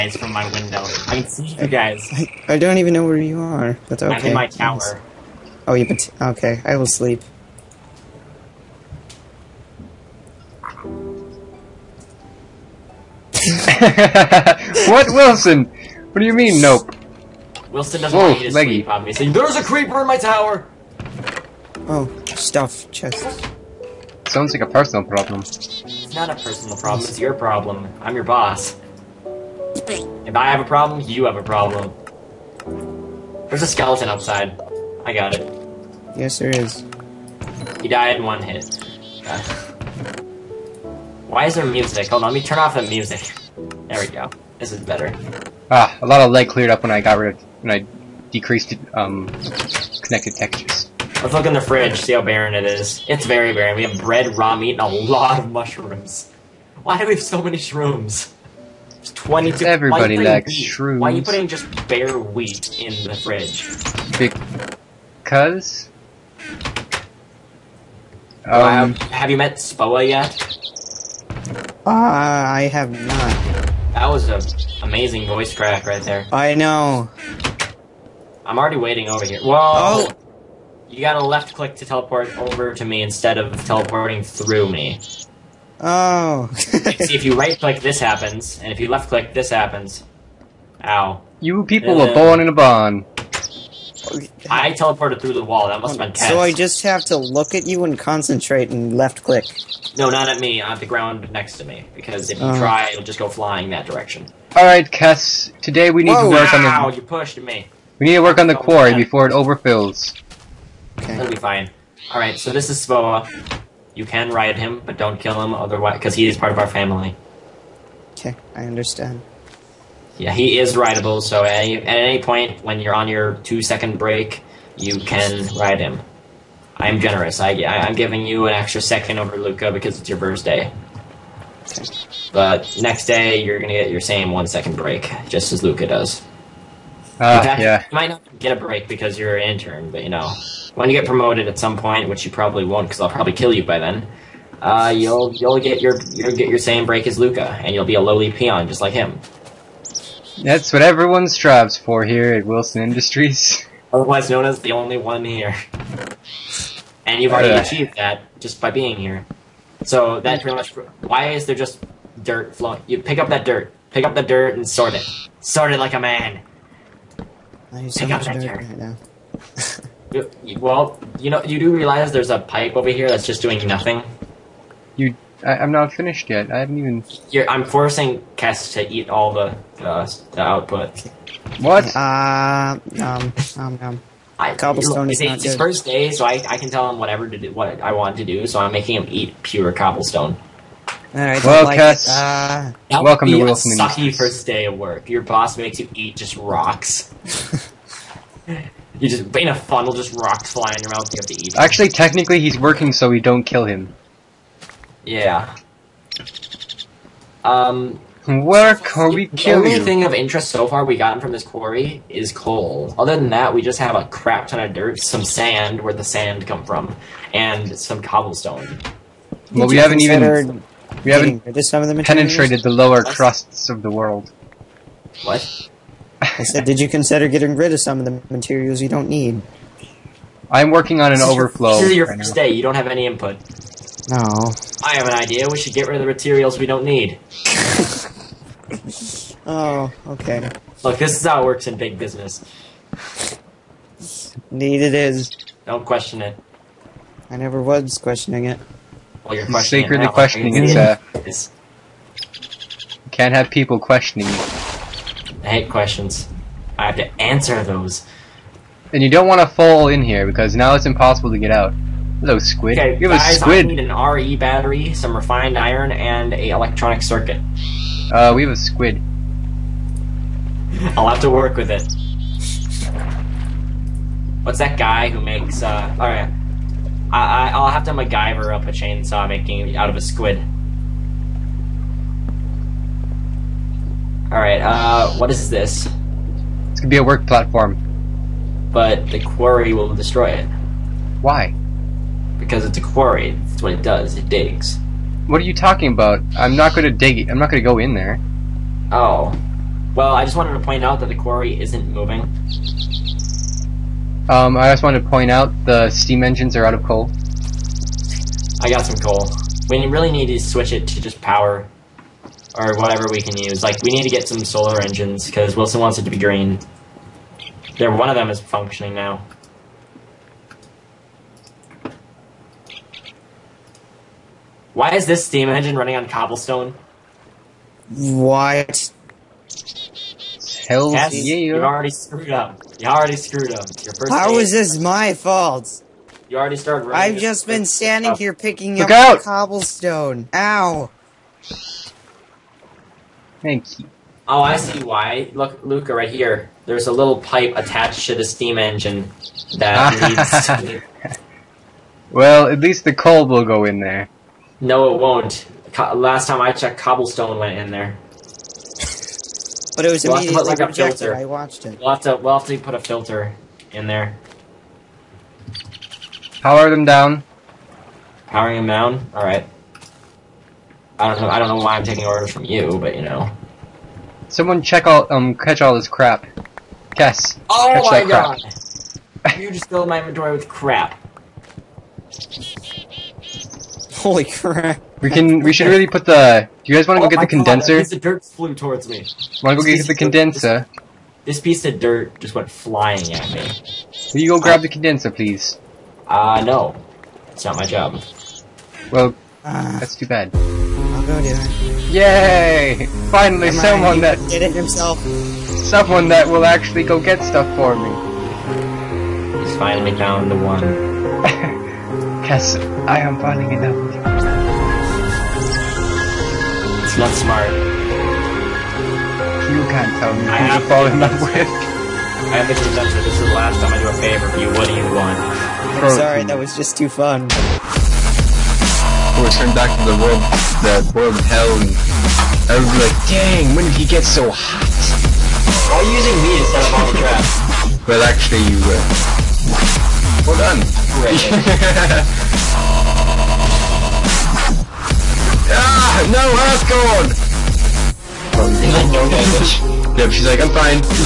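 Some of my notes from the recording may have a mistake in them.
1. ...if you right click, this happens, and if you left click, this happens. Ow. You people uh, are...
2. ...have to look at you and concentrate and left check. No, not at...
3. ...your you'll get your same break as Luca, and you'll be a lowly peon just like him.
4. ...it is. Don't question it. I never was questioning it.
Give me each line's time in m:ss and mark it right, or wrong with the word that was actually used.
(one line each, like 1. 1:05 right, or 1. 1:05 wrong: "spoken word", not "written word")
1. 1:27 right
2. 1:36 wrong: "click", not "check"
3. 2:25 right
4. 4:04 right.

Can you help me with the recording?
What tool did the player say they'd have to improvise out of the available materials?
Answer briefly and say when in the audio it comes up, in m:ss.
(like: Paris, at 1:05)
Chainsaw, at 4:38.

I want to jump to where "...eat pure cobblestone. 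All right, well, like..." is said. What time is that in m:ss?
3:09.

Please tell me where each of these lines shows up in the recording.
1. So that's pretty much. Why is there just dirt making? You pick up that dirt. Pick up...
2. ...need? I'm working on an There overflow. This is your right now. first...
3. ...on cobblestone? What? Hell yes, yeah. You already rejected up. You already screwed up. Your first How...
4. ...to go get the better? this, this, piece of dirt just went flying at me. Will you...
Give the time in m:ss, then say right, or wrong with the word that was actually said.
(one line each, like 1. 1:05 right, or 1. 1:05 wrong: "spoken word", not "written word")
1. 2:39 wrong: "flowing", not "making"
2. 3:49 wrong: "This", not "There"
3. 5:25 wrong: "screwed", not "rejected"
4. 6:29 wrong: "condenser", not "better".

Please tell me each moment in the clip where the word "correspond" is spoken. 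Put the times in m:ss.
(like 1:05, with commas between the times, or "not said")
not said.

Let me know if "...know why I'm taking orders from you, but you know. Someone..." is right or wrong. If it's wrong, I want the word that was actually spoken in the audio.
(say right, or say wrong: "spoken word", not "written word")
right.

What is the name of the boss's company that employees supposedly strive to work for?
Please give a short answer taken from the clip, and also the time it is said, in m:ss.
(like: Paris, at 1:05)
Wilson Industries, at 2:32.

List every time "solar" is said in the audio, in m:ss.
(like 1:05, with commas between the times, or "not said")
5:14.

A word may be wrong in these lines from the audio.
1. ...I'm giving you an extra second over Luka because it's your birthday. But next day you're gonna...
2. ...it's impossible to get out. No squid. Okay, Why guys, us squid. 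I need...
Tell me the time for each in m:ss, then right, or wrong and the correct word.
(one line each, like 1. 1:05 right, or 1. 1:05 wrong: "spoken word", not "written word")
1. 2:07 right
2. 4:20 wrong: "Give", not "Why".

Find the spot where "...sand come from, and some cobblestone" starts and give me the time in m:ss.
3:36.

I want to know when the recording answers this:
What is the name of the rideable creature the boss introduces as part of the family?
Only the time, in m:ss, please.
1:52.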